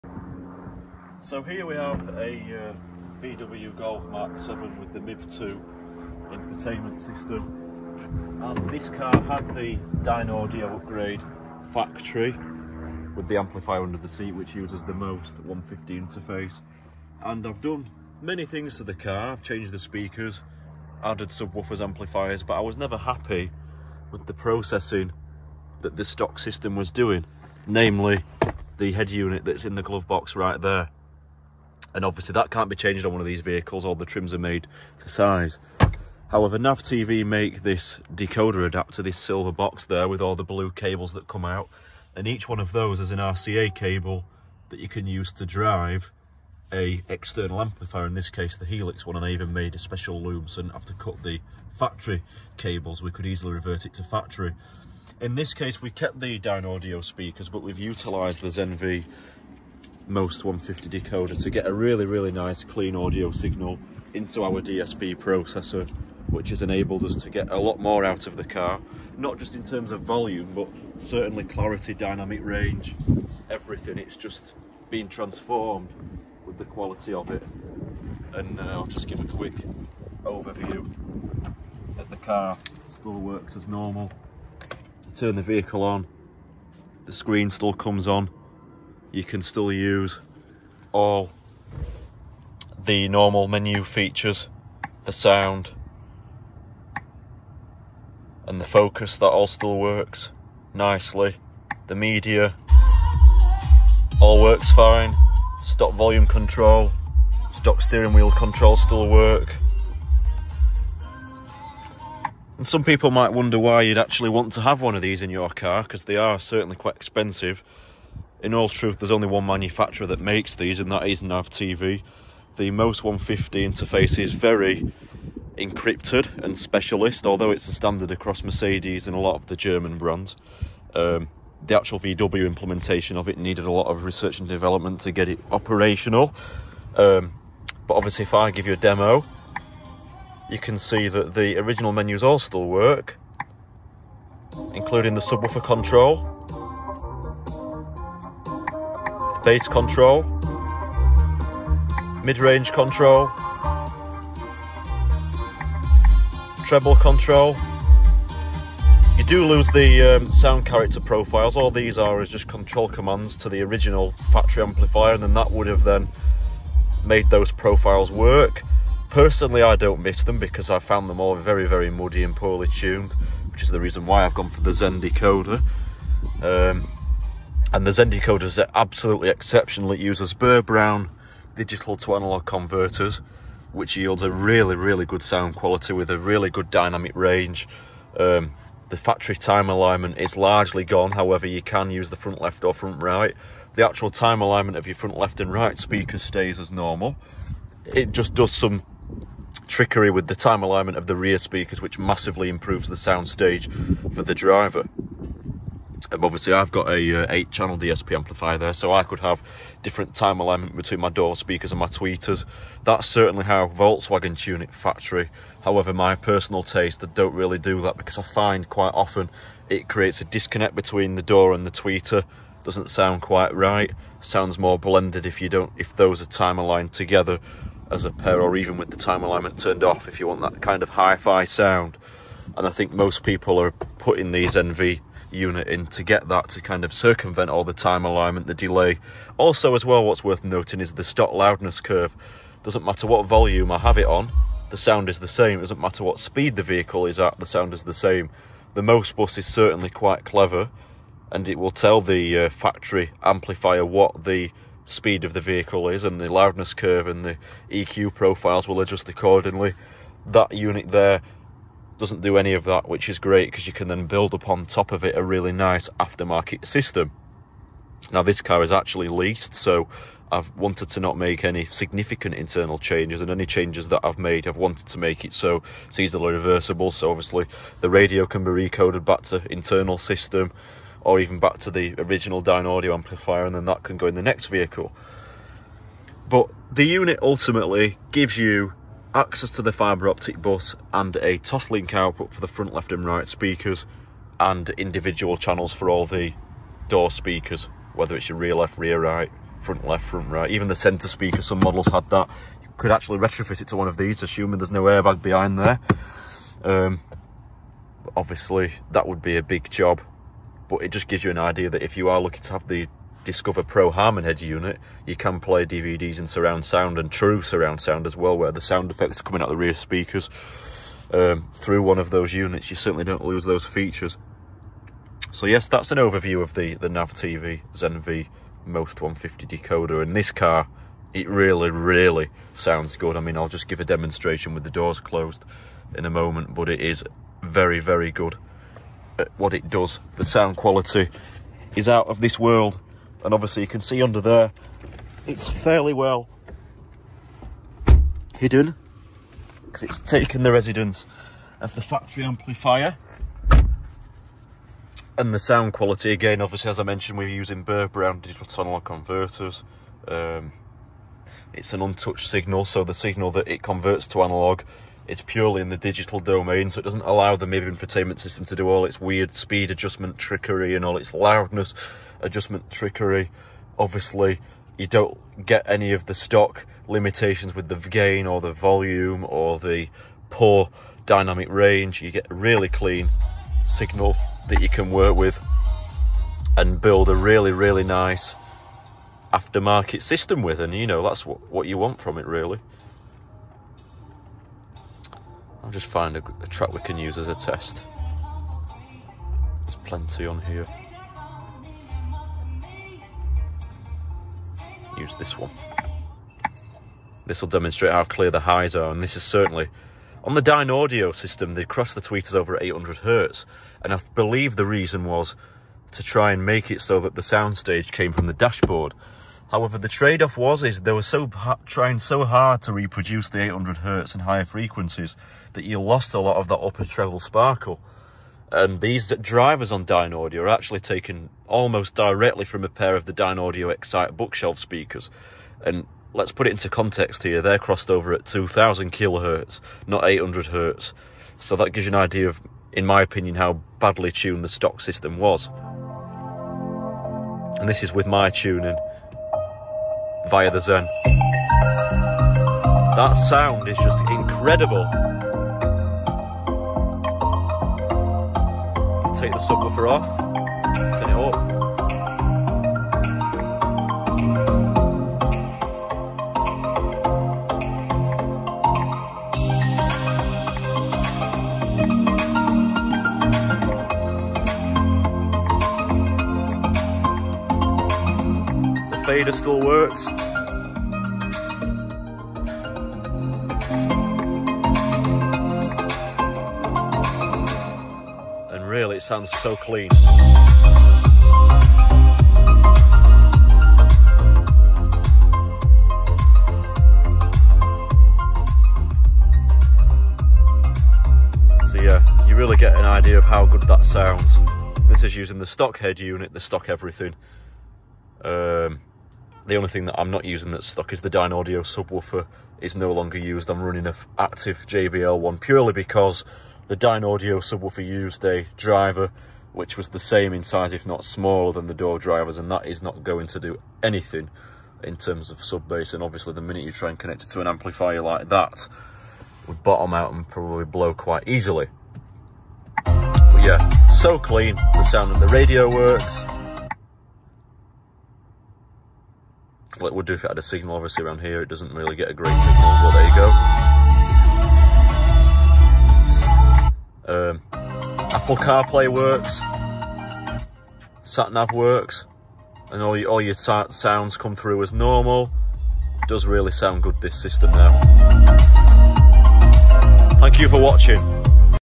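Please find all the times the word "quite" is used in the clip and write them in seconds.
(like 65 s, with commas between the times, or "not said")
116 s, 218 s, 223 s, 249 s, 530 s.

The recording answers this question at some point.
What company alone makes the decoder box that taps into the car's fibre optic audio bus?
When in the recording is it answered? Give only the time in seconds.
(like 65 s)
36 s.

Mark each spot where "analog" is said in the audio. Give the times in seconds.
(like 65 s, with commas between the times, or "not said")
182 s, 358 s, 364 s.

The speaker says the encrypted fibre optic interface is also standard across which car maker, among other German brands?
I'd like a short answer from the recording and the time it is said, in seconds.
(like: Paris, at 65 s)
Mercedes, at 128 s.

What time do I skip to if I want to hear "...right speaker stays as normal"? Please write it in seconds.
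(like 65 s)
195 s.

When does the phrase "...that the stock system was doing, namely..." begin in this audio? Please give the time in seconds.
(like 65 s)
25 s.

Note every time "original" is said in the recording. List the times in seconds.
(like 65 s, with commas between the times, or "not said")
141 s, 163 s, 281 s.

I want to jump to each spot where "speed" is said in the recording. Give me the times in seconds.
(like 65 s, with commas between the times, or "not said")
246 s, 254 s, 369 s.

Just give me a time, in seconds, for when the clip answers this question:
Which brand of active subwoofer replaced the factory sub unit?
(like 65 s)
514 s.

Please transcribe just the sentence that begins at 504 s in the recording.
This is using the stock head unit, the stock everything.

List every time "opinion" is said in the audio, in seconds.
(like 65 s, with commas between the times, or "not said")
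443 s.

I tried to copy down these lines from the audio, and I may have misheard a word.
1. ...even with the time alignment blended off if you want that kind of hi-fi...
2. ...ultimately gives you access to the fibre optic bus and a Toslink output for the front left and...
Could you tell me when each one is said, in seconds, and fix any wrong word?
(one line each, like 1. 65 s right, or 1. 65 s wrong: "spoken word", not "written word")
1. 228 s wrong: "turned", not "blended"
2. 287 s right.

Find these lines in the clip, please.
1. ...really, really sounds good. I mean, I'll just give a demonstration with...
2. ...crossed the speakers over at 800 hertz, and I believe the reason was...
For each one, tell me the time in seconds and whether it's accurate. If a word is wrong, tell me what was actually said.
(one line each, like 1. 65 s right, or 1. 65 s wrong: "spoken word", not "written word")
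1. 331 s right
2. 411 s wrong: "tweeters", not "speakers".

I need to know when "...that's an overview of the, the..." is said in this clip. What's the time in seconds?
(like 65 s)
325 s.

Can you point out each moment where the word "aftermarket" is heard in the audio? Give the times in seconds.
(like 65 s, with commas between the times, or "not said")
265 s, 389 s.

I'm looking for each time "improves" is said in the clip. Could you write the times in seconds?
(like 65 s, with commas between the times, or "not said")
202 s.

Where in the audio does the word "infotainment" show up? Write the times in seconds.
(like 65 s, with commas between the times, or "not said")
6 s, 367 s.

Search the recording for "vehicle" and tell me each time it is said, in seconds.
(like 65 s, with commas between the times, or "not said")
33 s, 85 s, 246 s, 255 s, 284 s.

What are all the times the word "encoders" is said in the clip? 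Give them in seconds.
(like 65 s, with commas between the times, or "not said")
177 s.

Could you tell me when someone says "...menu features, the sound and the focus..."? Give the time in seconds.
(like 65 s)
93 s.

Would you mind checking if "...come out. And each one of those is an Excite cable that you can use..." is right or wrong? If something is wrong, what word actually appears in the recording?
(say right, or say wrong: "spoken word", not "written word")
wrong: "RCA", not "Excite".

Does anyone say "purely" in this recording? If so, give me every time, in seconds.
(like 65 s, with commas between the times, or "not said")
365 s, 515 s.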